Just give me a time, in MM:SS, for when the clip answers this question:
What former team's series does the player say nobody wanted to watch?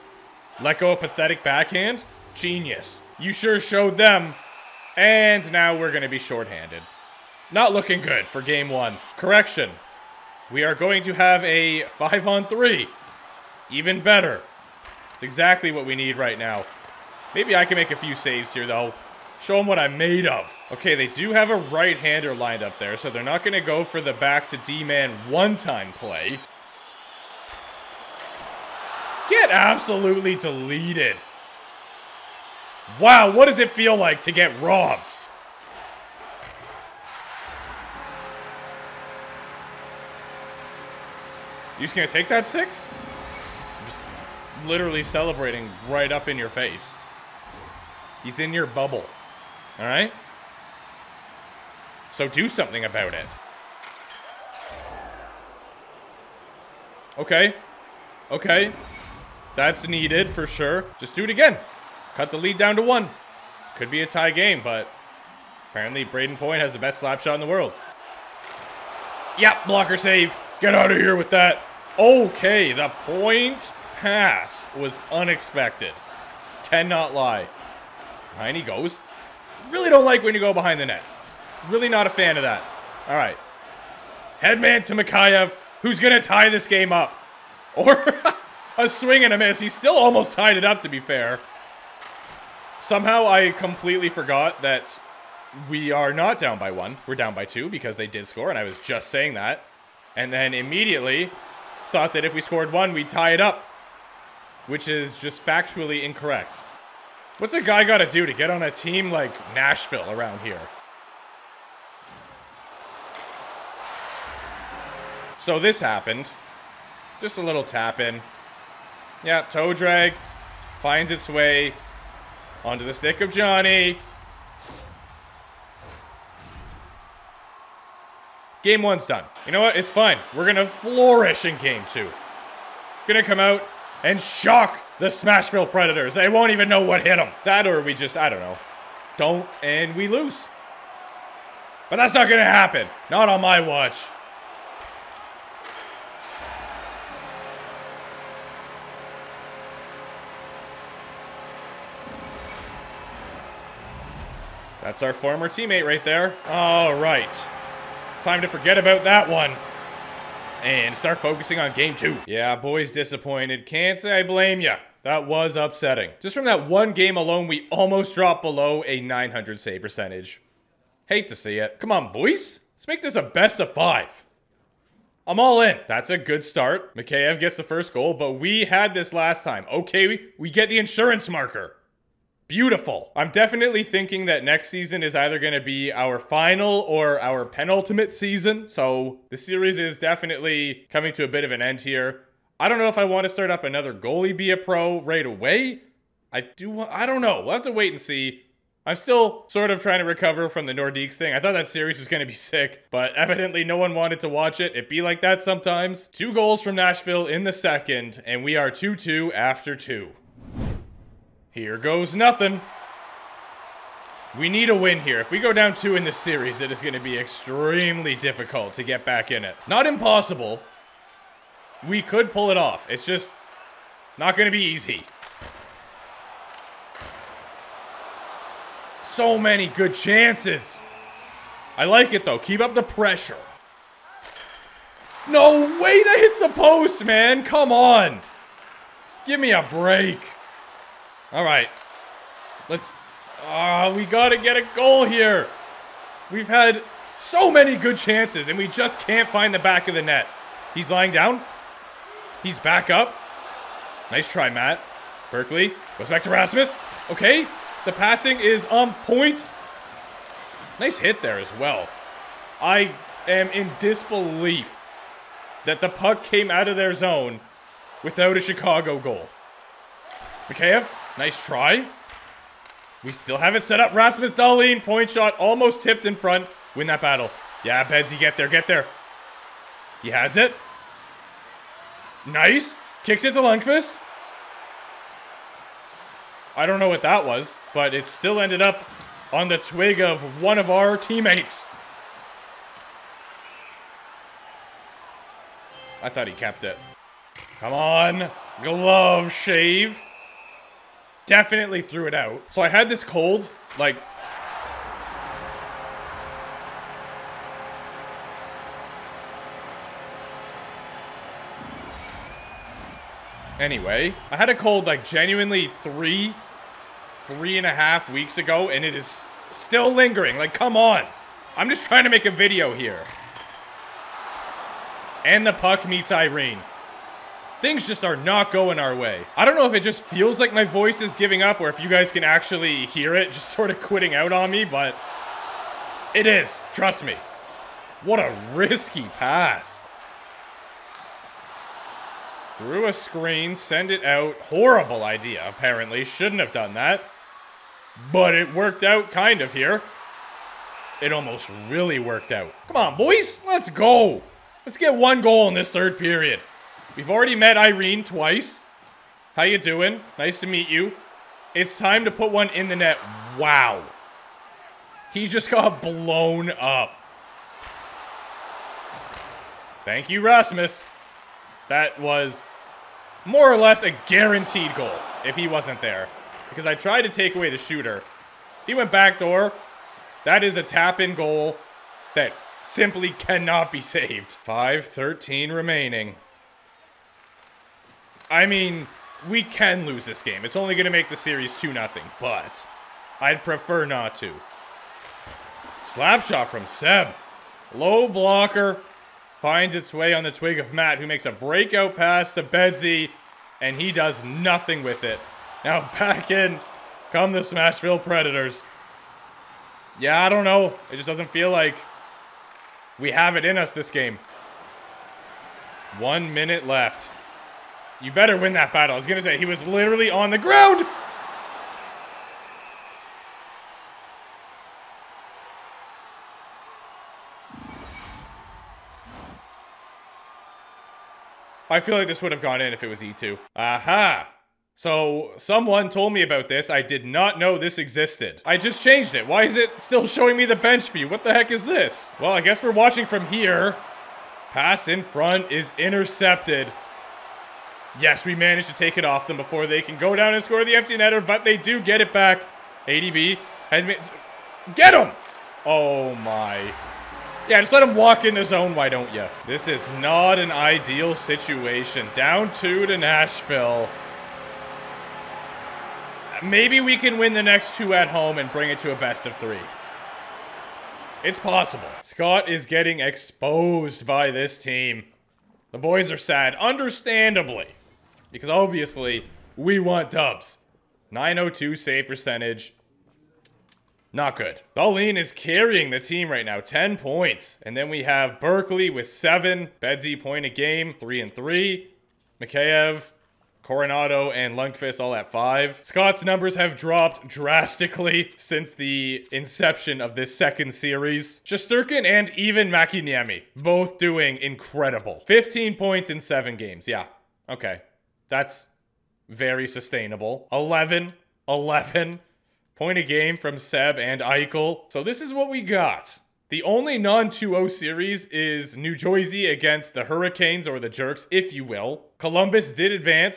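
03:20.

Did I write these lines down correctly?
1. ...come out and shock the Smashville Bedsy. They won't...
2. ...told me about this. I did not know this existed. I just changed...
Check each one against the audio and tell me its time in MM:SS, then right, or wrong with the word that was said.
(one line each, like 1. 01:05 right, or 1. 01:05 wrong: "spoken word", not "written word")
1. 02:13 wrong: "Predators", not "Bedsy"
2. 07:15 right.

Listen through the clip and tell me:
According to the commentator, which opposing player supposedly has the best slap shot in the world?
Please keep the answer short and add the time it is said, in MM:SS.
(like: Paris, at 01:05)
Brayden Point, at 01:06.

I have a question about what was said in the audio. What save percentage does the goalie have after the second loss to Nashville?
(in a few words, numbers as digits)
902.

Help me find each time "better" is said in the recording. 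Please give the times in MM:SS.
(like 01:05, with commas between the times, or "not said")
00:14, 06:58.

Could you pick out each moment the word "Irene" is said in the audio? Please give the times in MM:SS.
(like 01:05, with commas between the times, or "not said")
05:26, 05:57.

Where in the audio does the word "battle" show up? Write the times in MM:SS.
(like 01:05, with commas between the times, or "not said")
04:37, 06:58.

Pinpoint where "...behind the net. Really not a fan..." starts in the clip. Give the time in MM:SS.
01:20.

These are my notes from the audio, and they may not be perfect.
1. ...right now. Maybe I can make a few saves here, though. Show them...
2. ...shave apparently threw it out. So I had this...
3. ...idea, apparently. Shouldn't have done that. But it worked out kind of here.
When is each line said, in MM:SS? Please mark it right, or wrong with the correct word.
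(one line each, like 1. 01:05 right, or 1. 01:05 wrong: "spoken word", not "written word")
1. 00:16 right
2. 04:59 wrong: "definitely", not "apparently"
3. 05:45 right.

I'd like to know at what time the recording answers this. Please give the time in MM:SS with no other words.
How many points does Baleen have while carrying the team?
08:06.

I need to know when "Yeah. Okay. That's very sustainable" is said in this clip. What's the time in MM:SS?
08:26.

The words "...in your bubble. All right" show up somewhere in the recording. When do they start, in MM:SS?
00:48.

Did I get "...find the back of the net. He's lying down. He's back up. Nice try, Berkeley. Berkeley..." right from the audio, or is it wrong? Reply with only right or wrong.
wrong.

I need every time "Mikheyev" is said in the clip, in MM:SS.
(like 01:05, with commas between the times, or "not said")
01:24, 02:56, 04:30, 08:12.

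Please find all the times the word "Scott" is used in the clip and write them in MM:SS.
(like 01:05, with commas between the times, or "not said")
07:52, 08:15.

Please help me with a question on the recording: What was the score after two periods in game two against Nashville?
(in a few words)
2-2.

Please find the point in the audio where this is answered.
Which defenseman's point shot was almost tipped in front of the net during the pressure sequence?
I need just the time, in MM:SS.
04:33.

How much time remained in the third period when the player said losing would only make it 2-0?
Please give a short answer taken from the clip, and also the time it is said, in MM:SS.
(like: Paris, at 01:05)
5:13, at 06:24.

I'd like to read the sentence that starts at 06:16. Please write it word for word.
Because I tried to take away the shooter.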